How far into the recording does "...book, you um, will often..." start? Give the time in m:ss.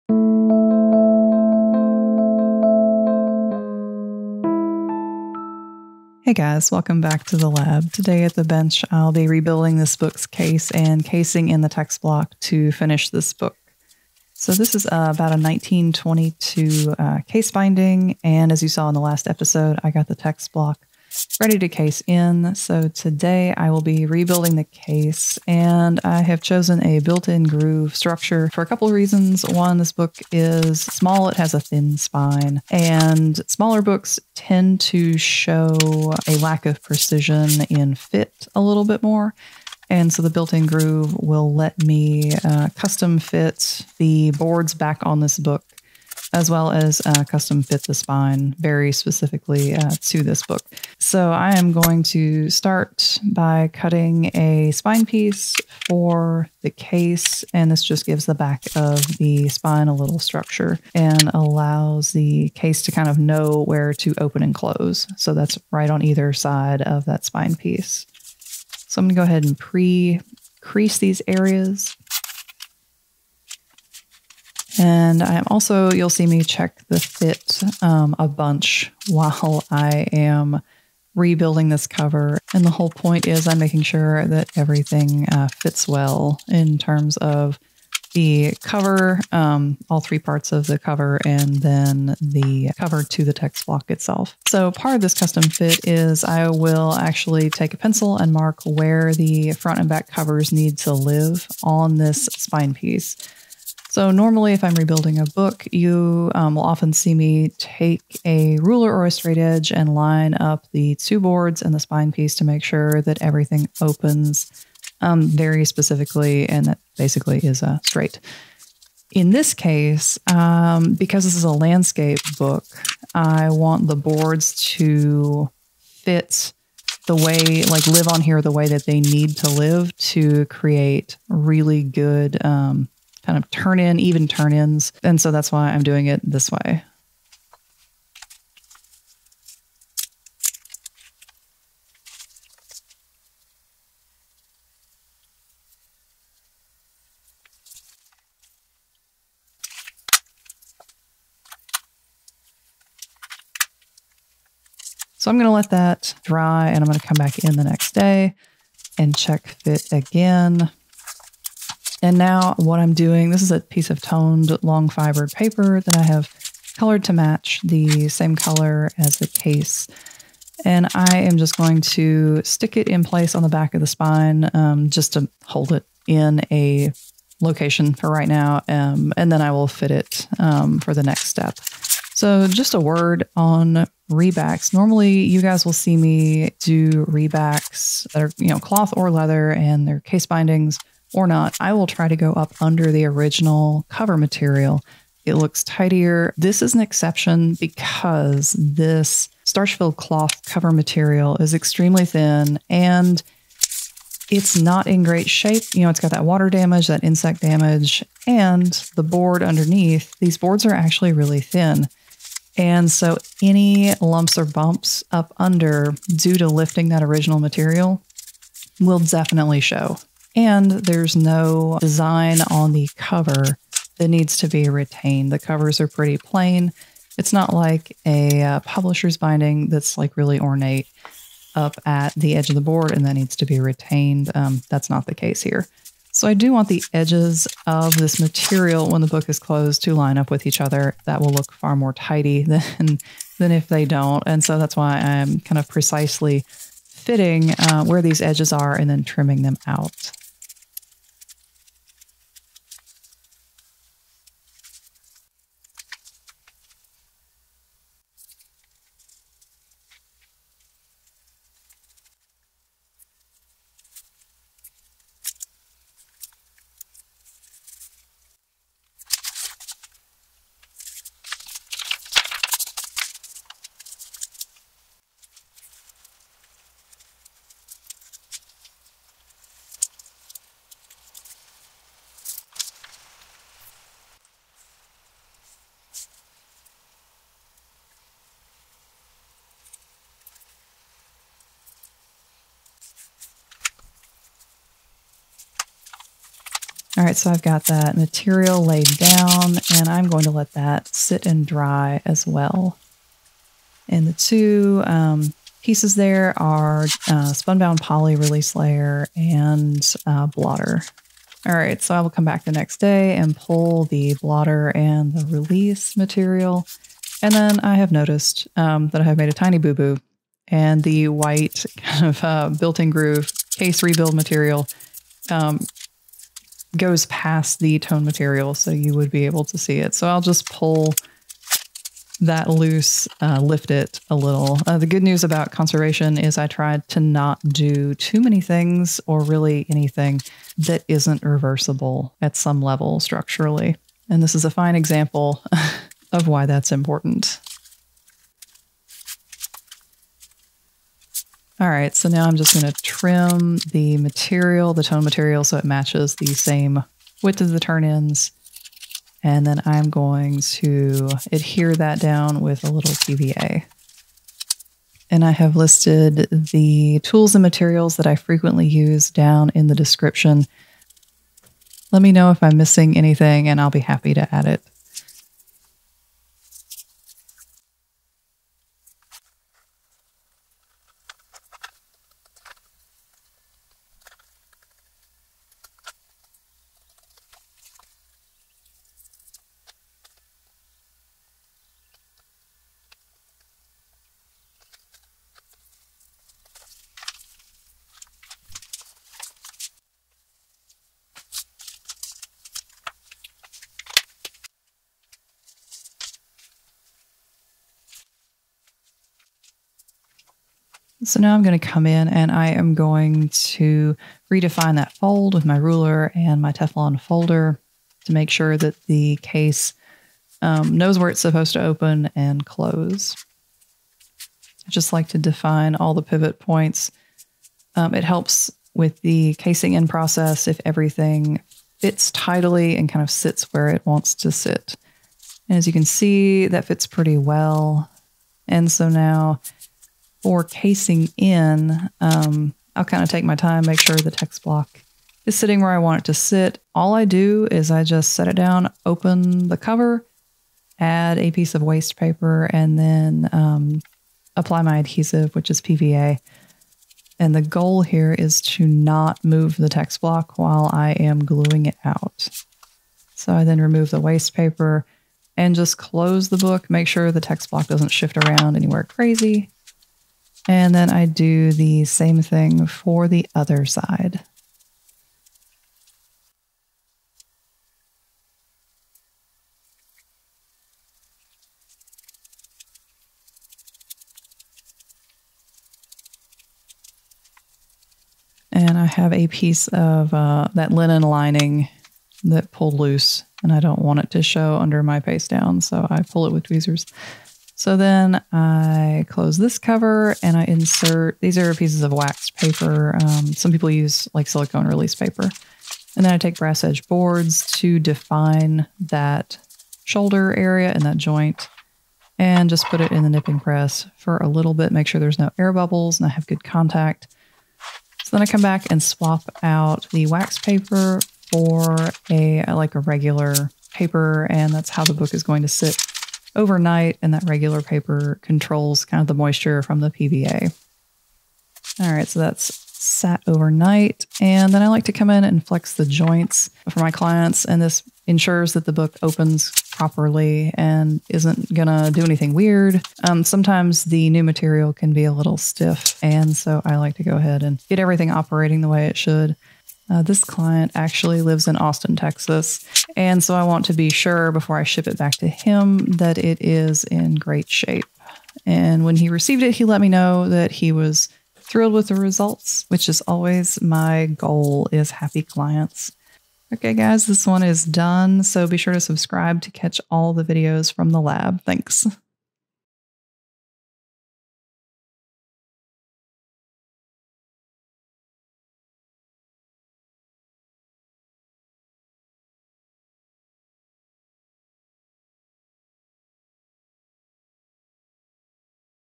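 1:45.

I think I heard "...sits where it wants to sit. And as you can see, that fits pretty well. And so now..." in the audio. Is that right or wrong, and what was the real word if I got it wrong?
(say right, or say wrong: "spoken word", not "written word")
right.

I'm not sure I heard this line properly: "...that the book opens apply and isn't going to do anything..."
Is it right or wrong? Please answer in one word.
wrong.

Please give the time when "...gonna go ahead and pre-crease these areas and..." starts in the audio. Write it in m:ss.
1:09.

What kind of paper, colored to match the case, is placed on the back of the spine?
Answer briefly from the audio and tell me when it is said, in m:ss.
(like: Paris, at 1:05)
toned long fibered paper, at 2:44.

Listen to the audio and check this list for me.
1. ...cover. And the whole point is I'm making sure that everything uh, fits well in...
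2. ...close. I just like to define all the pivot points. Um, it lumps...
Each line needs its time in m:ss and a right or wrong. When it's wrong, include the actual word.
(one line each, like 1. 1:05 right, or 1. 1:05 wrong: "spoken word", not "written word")
1. 1:21 right
2. 7:02 wrong: "helps", not "lumps".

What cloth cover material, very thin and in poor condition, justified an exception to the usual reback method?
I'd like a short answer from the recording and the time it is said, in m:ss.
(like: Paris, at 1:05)
starch-filled cloth, at 3:19.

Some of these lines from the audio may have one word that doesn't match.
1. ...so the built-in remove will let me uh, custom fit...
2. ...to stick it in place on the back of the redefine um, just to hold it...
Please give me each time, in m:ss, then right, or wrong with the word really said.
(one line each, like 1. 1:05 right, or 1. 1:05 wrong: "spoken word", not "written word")
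1. 0:40 wrong: "groove", not "remove"
2. 2:51 wrong: "spine", not "redefine".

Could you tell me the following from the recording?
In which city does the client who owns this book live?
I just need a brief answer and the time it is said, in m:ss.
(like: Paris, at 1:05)
Austin, Texas, at 9:11.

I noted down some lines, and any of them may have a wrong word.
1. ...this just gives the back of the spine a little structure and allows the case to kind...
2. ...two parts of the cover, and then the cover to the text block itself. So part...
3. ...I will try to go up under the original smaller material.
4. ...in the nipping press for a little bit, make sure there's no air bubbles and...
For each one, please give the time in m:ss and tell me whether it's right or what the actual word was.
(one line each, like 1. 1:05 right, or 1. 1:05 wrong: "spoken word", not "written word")
1. 0:57 right
2. 1:30 wrong: "three", not "two"
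3. 3:11 wrong: "cover", not "smaller"
4. 8:32 right.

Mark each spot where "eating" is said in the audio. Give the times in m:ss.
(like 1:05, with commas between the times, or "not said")
not said.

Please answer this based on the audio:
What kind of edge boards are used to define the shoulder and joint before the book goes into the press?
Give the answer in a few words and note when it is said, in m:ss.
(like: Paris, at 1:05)
brass edge boards, at 8:26.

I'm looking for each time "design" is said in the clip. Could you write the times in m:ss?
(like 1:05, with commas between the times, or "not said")
3:41.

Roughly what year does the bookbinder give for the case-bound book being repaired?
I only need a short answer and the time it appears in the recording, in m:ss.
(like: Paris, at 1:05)
1922, at 0:15.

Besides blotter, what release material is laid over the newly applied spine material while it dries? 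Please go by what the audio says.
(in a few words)
Spunbond Poly.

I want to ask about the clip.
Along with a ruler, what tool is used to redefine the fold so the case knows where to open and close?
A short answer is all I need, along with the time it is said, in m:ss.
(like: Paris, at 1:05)
Teflon folder, at 6:56.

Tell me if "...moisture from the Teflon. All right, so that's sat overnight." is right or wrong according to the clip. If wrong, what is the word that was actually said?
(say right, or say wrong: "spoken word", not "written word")
wrong: "PVA", not "Teflon".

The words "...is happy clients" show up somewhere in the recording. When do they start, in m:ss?
9:24.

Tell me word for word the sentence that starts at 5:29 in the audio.
So I'll just pull that loose, uh, lift it a little.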